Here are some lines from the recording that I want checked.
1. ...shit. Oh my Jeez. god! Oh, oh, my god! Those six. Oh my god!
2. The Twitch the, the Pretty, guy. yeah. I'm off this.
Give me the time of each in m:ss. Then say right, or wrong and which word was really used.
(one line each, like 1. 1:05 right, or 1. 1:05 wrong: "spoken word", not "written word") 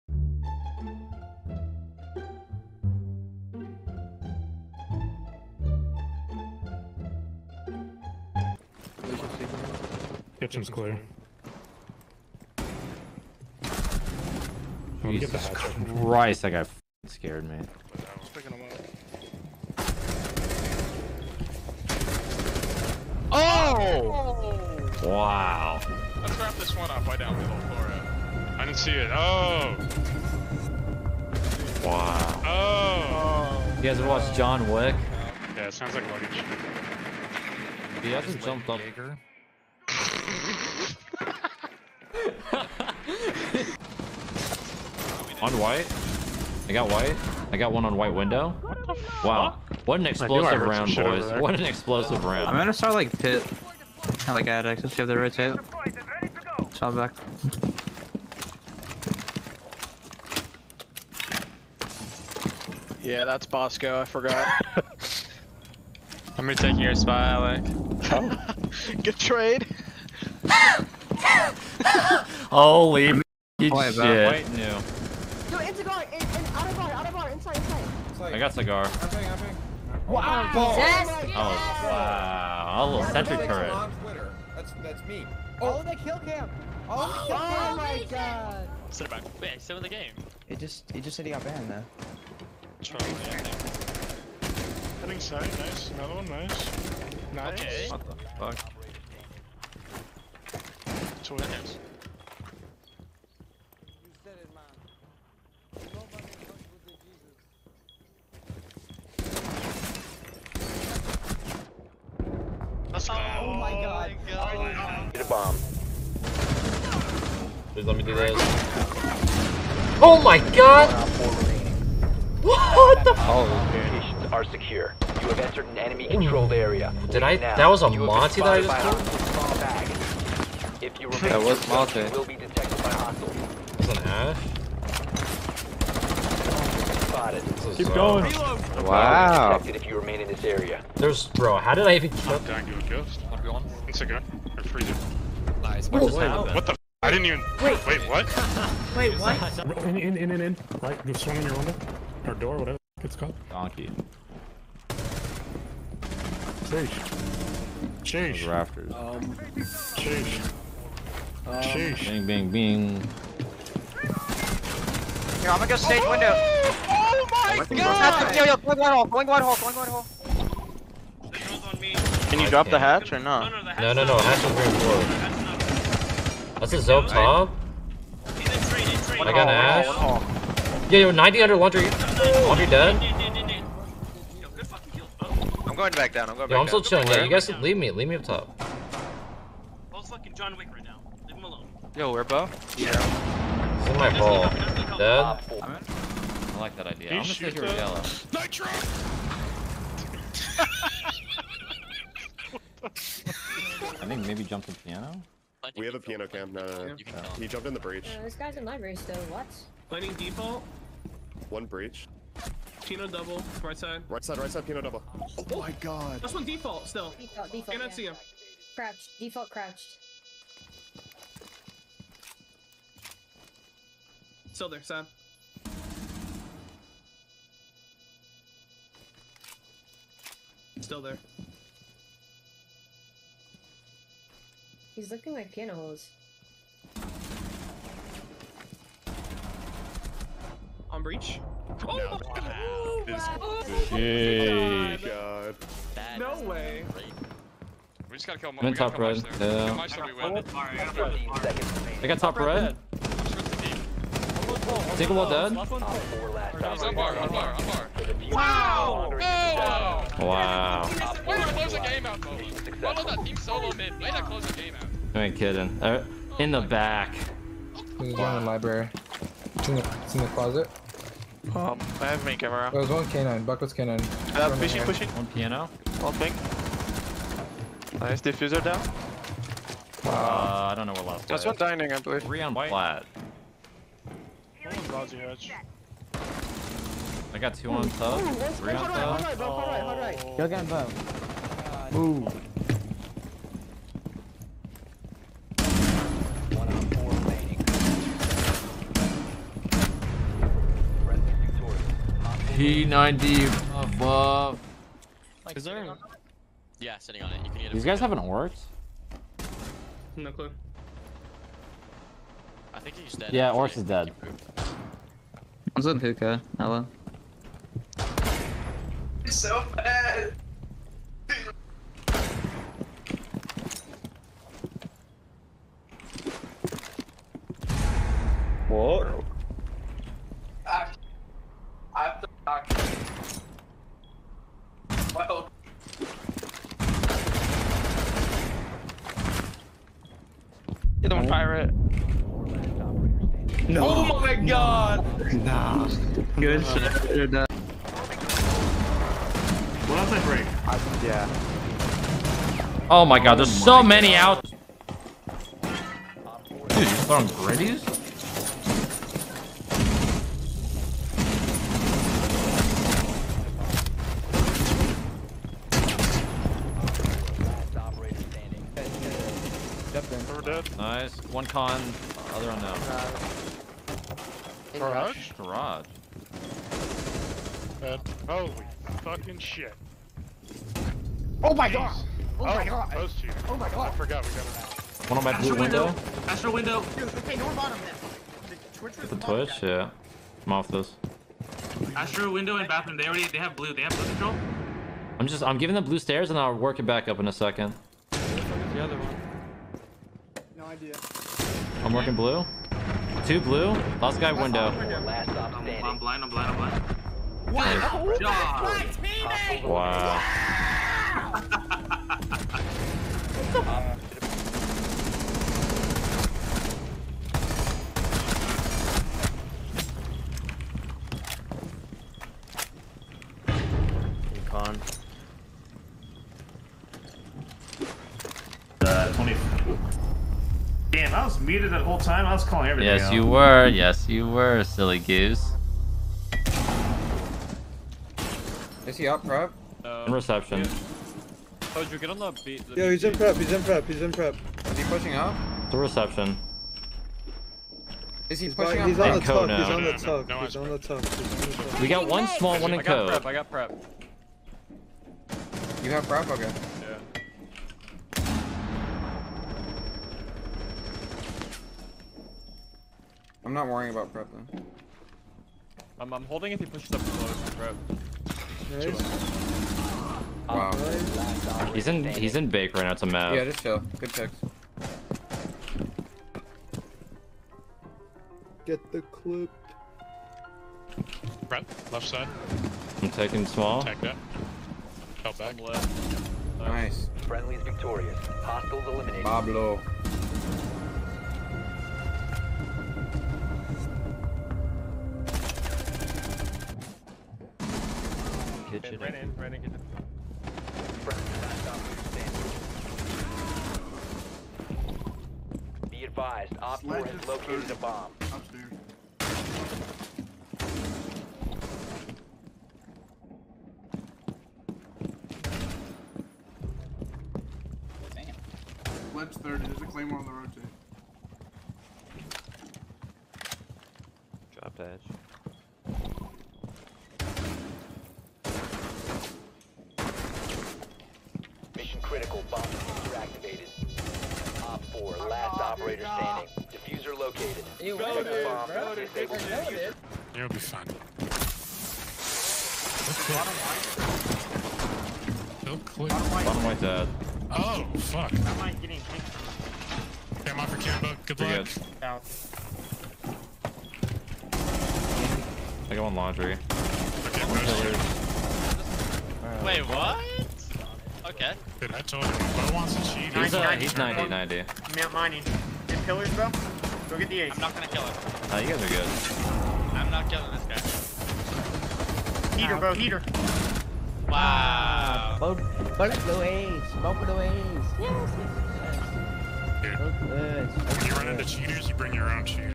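1. 6:19 wrong: "two", not "six"
2. 6:28 wrong: "Twitch", not "Pretty".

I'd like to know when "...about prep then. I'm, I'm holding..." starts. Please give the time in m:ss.
7:43.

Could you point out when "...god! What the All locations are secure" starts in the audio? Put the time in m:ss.
2:00.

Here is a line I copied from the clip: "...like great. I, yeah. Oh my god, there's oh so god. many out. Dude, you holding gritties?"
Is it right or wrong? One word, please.
wrong.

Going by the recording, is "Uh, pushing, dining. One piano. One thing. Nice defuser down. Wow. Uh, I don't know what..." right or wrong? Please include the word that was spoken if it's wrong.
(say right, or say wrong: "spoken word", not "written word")
wrong: "pushing", not "dining".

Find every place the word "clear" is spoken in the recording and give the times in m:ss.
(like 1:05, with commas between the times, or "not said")
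0:10, 9:05.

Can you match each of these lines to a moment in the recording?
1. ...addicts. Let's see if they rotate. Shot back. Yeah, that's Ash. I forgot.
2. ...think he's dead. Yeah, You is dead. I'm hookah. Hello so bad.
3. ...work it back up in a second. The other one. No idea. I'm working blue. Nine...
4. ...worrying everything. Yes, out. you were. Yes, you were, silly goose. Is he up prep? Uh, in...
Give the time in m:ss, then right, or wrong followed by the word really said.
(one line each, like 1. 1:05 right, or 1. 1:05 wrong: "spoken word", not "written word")
1. 0:54 wrong: "Bosco", not "Ash"
2. 5:12 wrong: "Orcs", not "You"
3. 6:36 wrong: "Two", not "Nine"
4. 7:12 wrong: "calling", not "worrying".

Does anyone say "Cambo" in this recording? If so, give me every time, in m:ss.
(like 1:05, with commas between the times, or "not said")
9:10.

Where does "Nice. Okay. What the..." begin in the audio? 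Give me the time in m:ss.
1:37.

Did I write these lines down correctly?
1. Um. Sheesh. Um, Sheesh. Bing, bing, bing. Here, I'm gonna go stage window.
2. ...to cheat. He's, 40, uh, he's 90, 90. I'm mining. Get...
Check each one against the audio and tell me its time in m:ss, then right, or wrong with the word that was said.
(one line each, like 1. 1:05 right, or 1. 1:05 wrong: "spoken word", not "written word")
1. 2:38 right
2. 9:22 wrong: "90", not "40".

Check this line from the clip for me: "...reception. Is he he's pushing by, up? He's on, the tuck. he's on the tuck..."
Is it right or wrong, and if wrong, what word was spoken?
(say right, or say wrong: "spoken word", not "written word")
right.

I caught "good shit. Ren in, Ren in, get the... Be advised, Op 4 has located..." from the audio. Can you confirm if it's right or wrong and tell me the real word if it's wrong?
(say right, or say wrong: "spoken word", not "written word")
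right.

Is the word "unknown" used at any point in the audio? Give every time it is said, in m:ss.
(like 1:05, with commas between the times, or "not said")
6:12.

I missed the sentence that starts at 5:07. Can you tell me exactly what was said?
You can get These guys have an worked.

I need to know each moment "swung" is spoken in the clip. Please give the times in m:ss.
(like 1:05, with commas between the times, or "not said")
2:31.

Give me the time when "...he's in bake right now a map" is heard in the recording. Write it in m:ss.
7:52.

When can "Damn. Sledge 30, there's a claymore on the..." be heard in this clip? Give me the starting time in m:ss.
8:38.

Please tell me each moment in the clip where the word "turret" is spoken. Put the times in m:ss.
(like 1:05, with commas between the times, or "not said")
1:23.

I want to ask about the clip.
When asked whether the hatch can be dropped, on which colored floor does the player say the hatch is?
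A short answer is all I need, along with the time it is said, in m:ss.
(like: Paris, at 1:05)
green floor, at 2:54.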